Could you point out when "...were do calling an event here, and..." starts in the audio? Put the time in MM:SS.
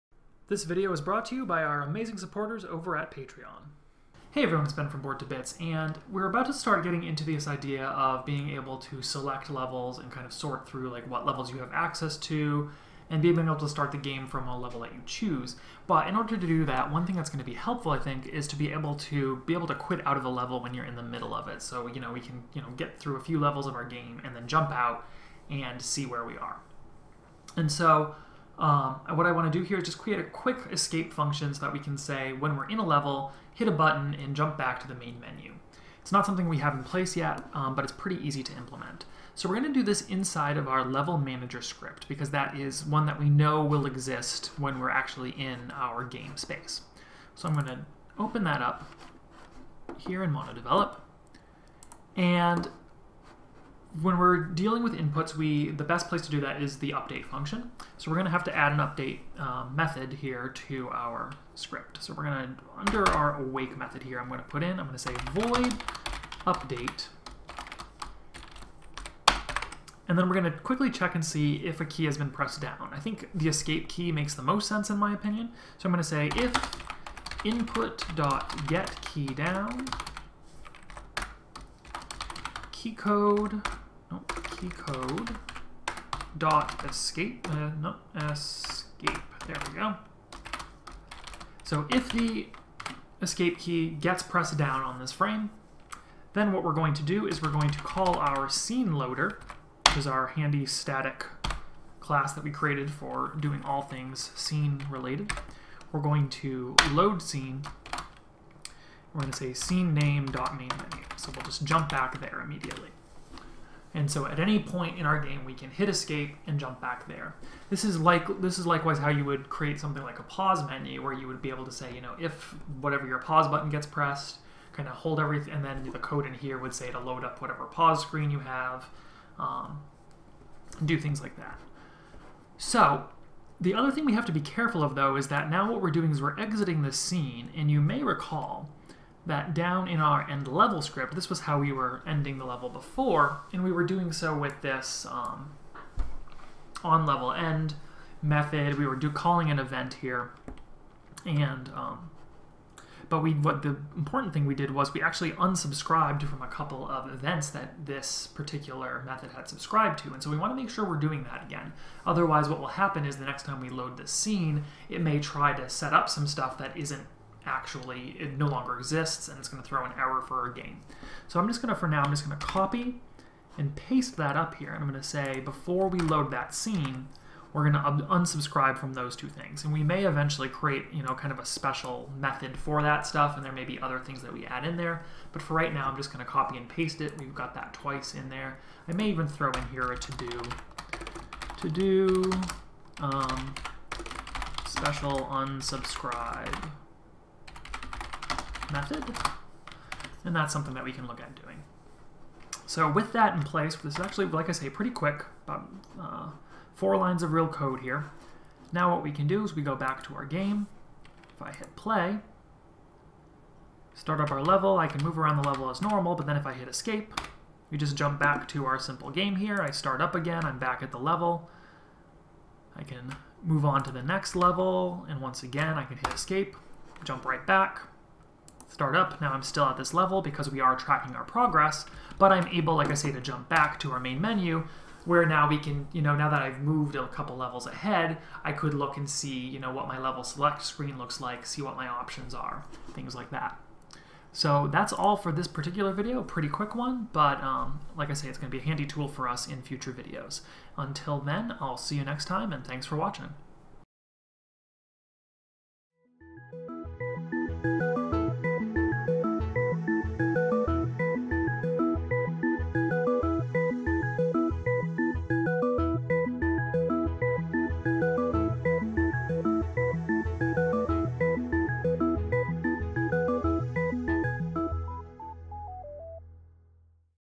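02:28.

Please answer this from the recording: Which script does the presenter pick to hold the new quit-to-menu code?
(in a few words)
level manager.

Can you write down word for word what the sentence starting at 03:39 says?
I start up again, I'm back at the level.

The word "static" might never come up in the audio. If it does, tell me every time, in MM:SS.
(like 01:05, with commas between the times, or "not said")
01:40.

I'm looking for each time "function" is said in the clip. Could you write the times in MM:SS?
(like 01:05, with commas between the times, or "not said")
00:31, 00:57.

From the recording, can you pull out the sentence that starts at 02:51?
So I'm just going to, for now, I'm just going to copy and paste that up here.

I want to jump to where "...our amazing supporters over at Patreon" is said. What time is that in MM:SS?
00:01.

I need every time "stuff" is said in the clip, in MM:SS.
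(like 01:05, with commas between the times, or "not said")
02:46, 03:03.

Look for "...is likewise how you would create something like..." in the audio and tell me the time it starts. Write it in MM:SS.
01:58.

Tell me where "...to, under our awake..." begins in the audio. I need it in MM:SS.
01:02.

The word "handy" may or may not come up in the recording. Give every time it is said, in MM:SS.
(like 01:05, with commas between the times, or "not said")
01:40, 04:08.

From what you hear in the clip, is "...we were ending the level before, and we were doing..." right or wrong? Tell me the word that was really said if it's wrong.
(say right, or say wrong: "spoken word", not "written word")
right.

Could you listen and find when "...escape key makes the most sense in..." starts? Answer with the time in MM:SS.
01:13.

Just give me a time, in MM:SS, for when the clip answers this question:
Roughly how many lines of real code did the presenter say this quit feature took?
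03:26.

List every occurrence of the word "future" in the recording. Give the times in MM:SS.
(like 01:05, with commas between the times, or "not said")
04:09.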